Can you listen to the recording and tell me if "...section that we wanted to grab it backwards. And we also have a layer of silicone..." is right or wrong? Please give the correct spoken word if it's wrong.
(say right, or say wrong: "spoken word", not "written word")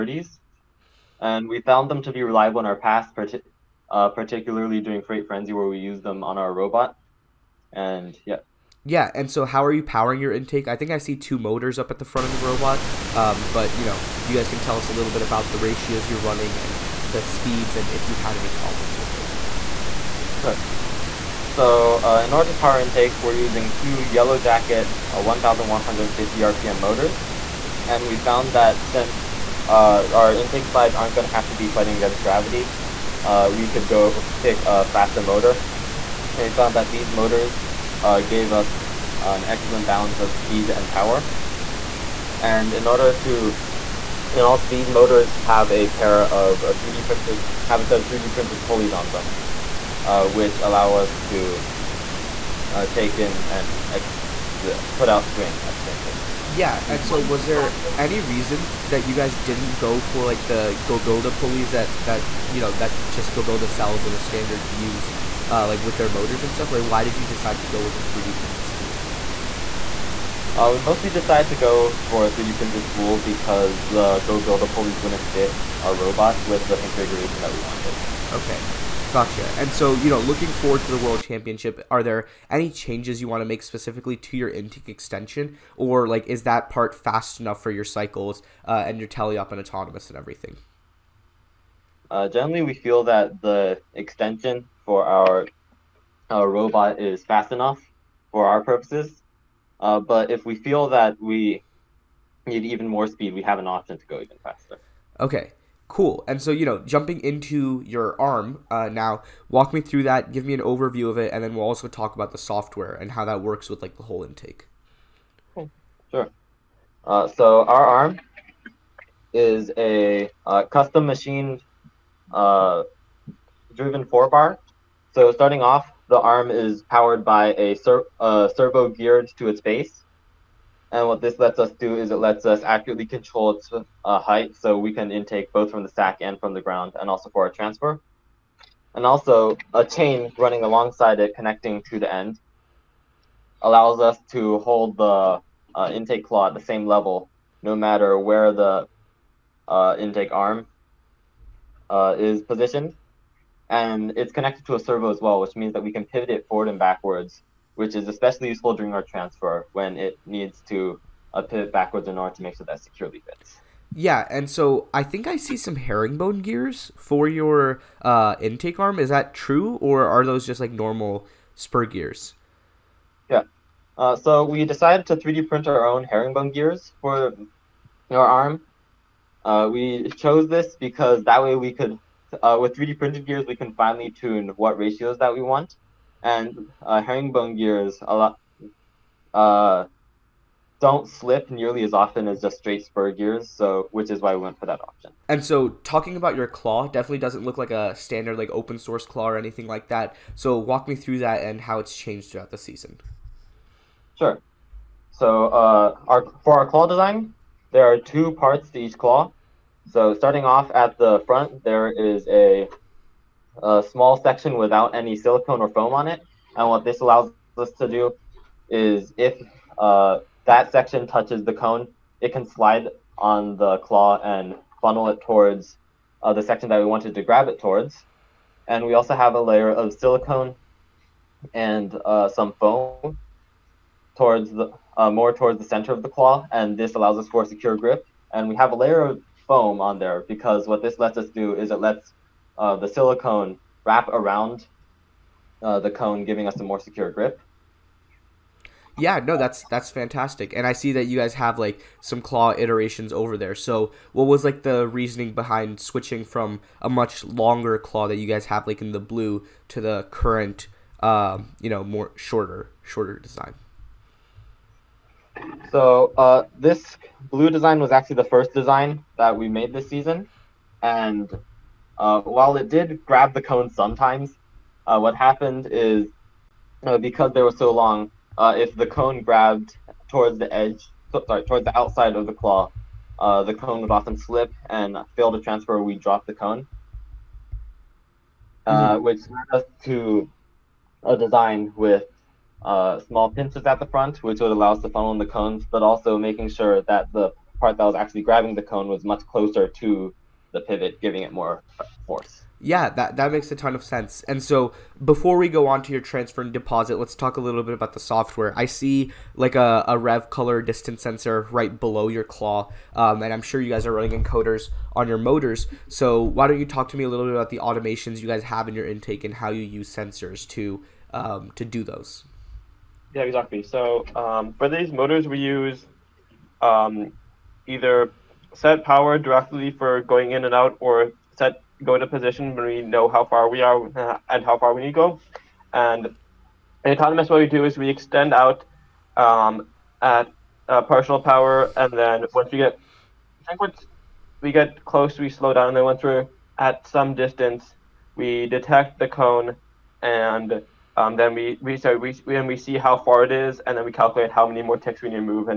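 wrong: "towards", not "backwards".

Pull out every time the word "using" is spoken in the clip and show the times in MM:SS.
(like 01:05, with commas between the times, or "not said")
00:23.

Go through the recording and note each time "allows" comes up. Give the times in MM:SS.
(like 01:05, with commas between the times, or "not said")
00:50, 02:23, 03:36, 03:56, 04:54.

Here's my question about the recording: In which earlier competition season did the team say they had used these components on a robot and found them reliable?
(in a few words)
Freight Frenzy.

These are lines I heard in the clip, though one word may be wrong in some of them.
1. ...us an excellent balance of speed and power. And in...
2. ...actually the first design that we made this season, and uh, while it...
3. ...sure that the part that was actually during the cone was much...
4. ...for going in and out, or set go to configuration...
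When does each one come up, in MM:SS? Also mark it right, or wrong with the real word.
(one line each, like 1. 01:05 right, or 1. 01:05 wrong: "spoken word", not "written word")
1. 00:38 right
2. 04:27 right
3. 04:56 wrong: "grabbing", not "during"
4. 05:29 wrong: "position", not "configuration".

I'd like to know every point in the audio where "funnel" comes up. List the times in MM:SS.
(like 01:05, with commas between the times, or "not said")
03:44, 04:54.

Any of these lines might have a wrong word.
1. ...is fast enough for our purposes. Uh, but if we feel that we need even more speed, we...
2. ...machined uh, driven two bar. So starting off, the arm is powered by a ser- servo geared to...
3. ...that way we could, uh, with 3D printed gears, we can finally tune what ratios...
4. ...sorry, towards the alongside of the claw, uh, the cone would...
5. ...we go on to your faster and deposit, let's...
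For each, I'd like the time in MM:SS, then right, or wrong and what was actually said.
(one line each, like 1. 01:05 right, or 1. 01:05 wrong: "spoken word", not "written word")
1. 01:36 right
2. 02:01 wrong: "four", not "two"
3. 03:01 right
4. 04:41 wrong: "outside", not "alongside"
5. 05:05 wrong: "transfer", not "faster".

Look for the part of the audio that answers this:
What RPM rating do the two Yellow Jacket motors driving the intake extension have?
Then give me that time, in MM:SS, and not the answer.
00:25.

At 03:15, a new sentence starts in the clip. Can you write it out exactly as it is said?
And so talking about your claw definitely doesn't look like a standard like open source claw or anything like that.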